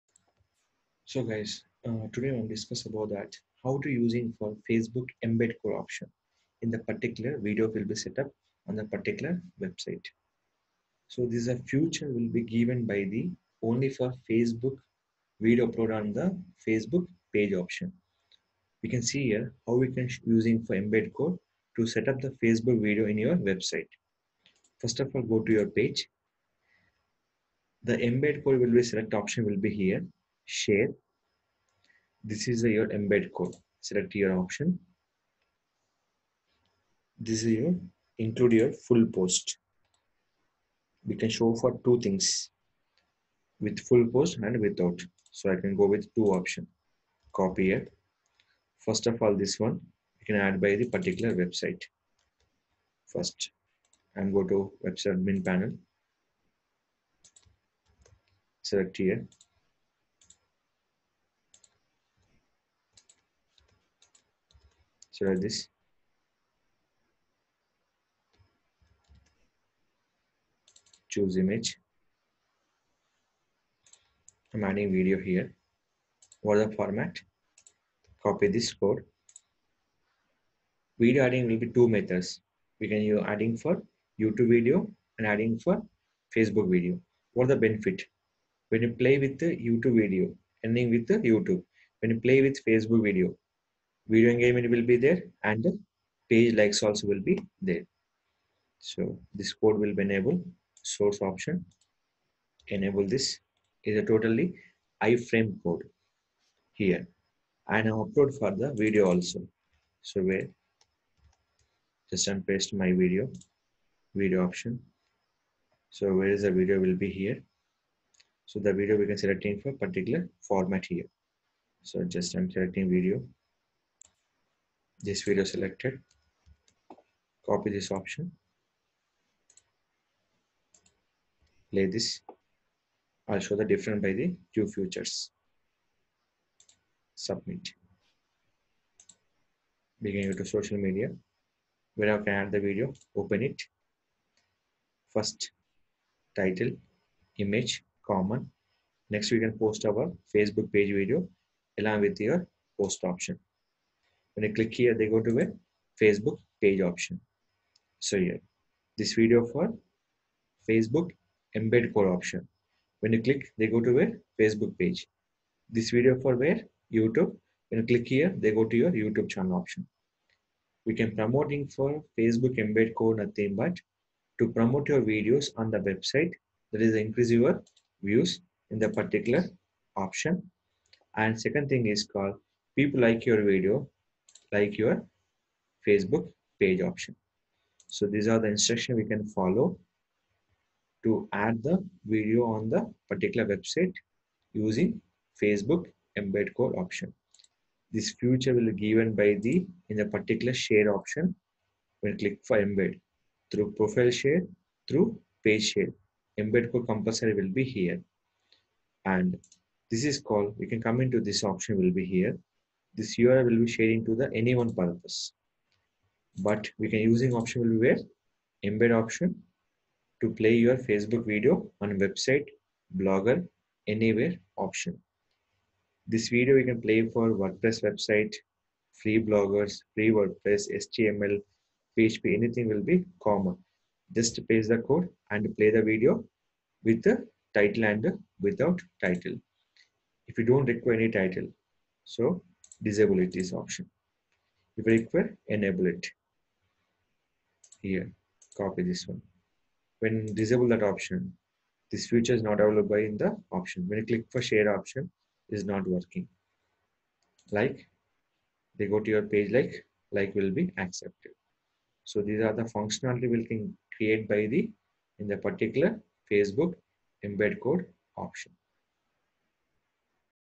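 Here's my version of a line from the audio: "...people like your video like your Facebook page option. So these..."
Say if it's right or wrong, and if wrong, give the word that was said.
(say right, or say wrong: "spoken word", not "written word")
right.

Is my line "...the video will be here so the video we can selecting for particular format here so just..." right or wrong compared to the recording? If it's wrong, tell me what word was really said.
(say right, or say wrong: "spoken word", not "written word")
right.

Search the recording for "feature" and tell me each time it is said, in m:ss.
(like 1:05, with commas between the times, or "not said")
3:18, 4:12.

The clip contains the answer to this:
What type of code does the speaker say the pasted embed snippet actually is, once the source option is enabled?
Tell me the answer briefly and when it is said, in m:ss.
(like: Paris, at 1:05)
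iframe code, at 1:45.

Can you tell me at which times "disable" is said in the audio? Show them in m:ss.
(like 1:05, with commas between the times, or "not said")
4:02, 4:10.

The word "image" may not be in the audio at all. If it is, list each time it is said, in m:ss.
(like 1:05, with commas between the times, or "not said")
1:11, 2:27.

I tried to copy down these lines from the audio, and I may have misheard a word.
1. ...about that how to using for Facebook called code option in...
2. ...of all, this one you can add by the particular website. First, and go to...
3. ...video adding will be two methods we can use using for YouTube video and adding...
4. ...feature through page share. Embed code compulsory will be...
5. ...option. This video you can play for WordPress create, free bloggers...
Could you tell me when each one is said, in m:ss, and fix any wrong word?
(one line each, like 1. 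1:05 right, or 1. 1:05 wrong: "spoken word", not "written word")
1. 0:02 wrong: "embed", not "called"
2. 0:49 right
3. 1:20 wrong: "adding", not "using"
4. 3:24 wrong: "share", not "feature"
5. 3:44 wrong: "website", not "create".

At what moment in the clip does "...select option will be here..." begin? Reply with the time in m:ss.
0:28.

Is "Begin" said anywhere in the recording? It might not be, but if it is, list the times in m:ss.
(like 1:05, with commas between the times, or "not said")
2:20.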